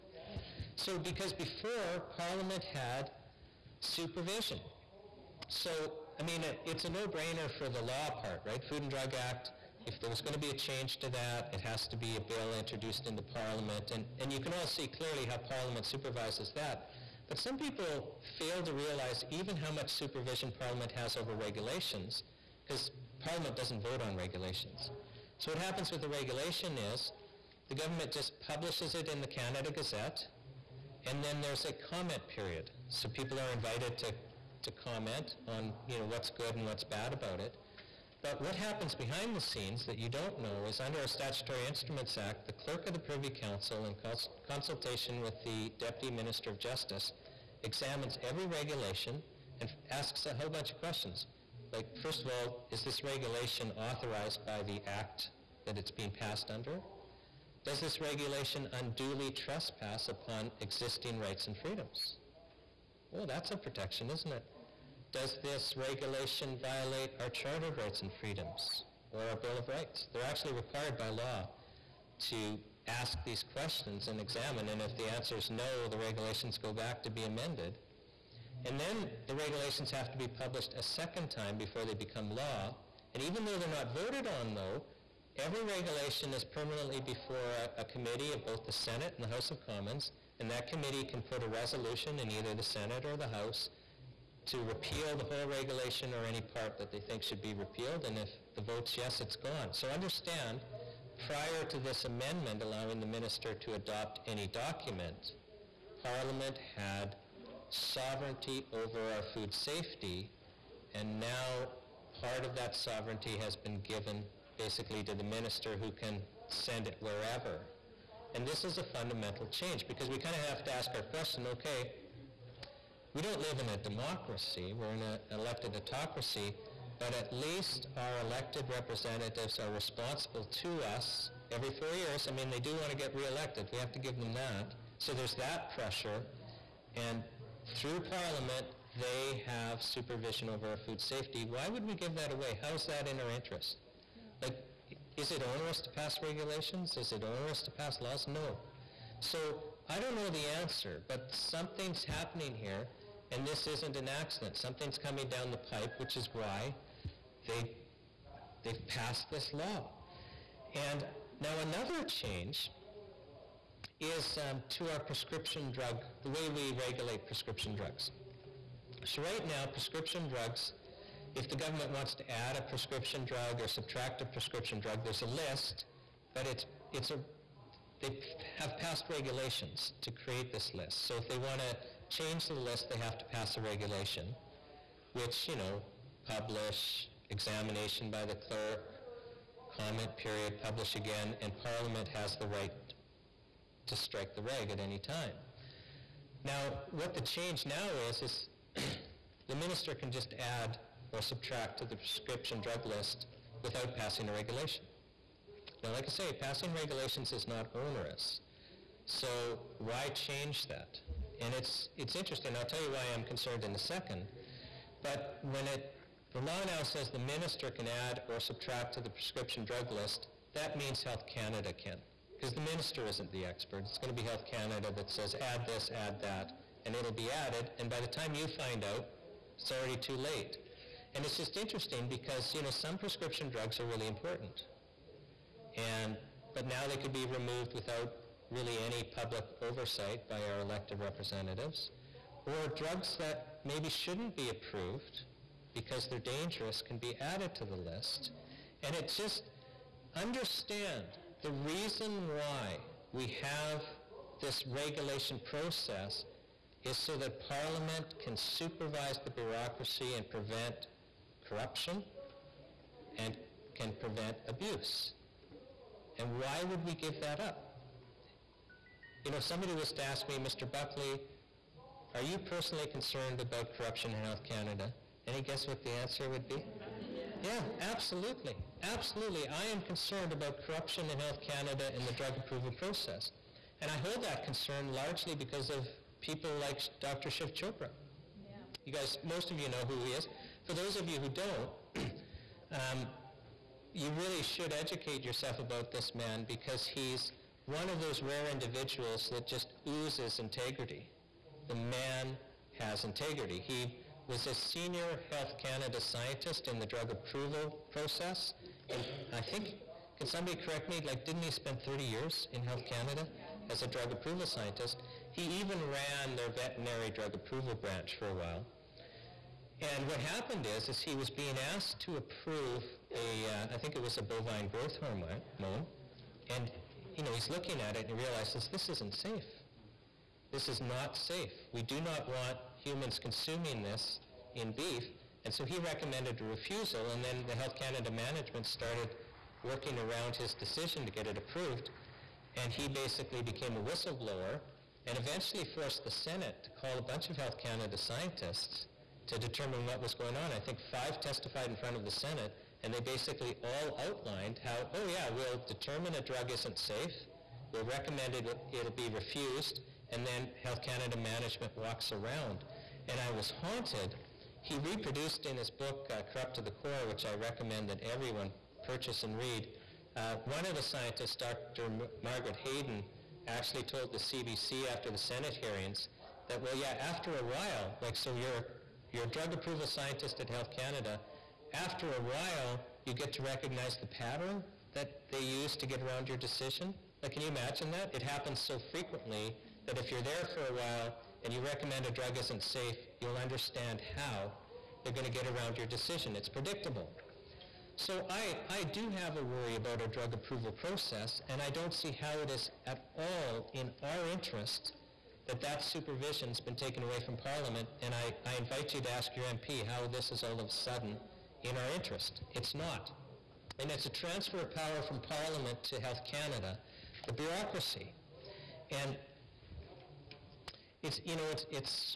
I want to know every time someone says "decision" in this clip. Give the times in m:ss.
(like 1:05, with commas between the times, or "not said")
5:40, 6:26, 6:35.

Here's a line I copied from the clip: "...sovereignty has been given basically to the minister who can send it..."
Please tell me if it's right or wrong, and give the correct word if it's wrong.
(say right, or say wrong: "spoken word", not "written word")
right.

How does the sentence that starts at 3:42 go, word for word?
Because the minister isn't the expert.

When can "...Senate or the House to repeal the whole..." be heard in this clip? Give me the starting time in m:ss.
1:32.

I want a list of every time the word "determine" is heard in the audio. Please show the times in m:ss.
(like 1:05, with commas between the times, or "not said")
5:49, 5:55.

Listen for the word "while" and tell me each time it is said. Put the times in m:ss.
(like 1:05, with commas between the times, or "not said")
5:18, 6:17, 6:22, 6:30.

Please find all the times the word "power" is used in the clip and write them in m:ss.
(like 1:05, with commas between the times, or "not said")
6:54.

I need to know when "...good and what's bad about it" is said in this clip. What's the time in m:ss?
0:36.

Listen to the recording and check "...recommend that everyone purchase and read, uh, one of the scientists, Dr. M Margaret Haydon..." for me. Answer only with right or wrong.
right.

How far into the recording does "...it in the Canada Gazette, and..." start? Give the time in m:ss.
0:28.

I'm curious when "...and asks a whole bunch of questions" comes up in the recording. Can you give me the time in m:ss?
0:49.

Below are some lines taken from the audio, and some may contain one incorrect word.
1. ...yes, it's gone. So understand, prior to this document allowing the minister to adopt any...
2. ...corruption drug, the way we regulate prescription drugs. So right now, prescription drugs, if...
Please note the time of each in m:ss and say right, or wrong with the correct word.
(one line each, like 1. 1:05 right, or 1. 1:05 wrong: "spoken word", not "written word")
1. 1:38 wrong: "amendment", not "document"
2. 2:44 wrong: "prescription", not "corruption".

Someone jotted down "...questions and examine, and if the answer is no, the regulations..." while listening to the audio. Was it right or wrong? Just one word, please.
right.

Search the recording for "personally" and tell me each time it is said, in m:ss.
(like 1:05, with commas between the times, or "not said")
4:32.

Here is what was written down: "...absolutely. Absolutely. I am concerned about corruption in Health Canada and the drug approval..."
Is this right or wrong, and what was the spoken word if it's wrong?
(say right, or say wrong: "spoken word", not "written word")
right.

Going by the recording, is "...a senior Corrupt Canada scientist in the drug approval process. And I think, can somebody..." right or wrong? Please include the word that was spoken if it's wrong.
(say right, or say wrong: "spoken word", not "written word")
wrong: "Health", not "Corrupt".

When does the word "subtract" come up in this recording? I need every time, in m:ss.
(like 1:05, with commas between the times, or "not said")
2:53, 3:21, 3:38.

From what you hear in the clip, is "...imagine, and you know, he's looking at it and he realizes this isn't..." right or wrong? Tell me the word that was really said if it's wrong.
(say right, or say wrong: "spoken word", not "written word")
wrong: "hormone", not "imagine".